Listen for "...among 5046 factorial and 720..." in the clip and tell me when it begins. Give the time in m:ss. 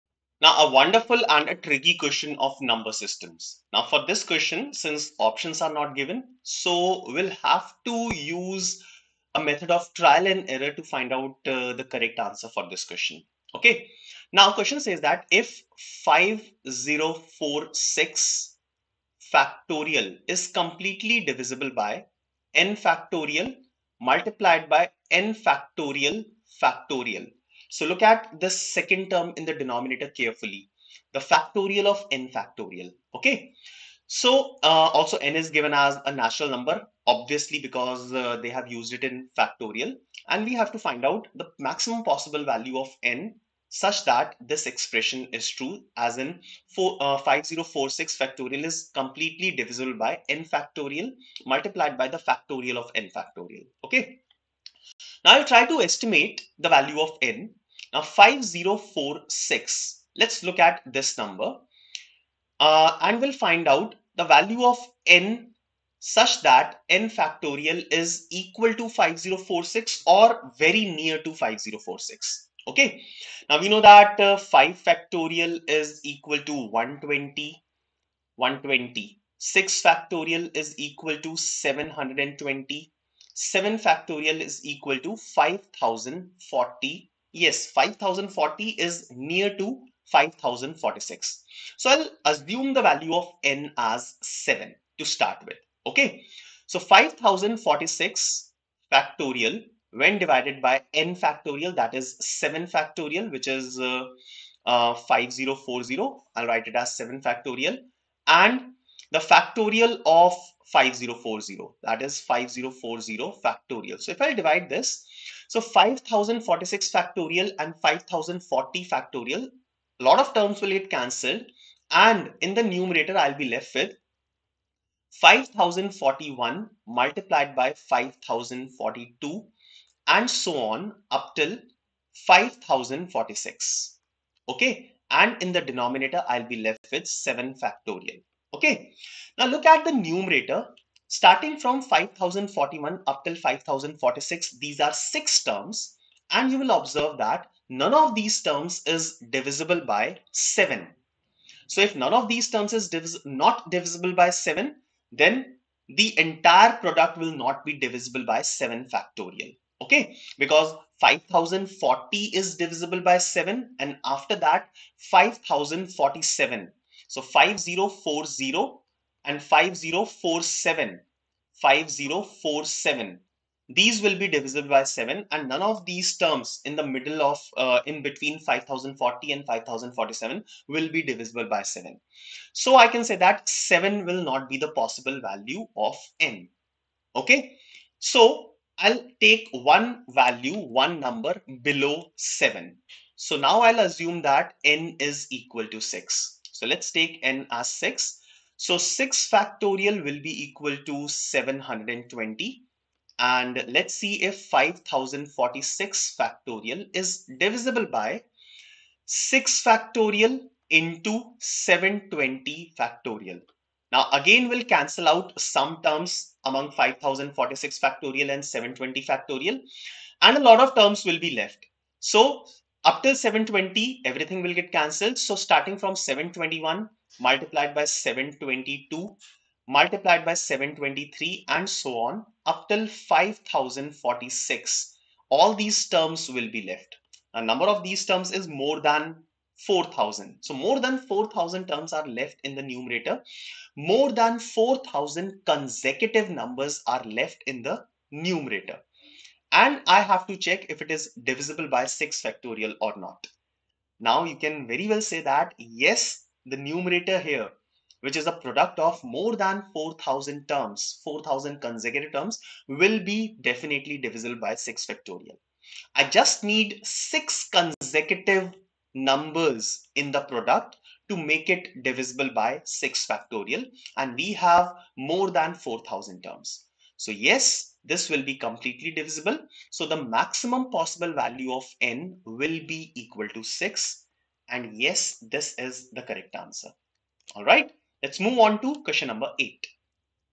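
3:36.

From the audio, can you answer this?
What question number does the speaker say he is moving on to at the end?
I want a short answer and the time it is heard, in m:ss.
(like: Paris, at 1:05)
8, at 4:48.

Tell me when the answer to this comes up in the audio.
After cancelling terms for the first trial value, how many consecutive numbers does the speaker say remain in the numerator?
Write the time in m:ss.
2:24.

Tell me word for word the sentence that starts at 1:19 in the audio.
6 factorial is equal to 720.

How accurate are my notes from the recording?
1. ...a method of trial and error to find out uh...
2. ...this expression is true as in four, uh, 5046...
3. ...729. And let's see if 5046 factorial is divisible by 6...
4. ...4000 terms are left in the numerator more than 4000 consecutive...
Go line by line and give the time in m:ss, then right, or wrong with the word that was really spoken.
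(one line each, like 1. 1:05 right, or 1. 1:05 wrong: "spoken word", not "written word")
1. 0:09 right
2. 0:44 right
3. 3:21 wrong: "720", not "729"
4. 4:00 right.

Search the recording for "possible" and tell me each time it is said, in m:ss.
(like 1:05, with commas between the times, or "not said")
0:42, 3:04, 4:40.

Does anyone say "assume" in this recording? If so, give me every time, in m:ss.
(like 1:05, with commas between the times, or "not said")
1:32, 3:13.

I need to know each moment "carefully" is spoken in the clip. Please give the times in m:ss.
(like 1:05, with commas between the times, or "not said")
0:30.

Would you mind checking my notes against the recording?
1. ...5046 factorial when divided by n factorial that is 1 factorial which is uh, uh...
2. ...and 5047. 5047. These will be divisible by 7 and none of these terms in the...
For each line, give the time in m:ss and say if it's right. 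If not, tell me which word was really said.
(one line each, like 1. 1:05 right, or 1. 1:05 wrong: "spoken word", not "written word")
1. 1:36 wrong: "7", not "1"
2. 2:49 right.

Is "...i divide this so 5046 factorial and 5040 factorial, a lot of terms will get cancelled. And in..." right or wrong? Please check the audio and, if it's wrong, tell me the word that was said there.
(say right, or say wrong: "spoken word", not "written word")
right.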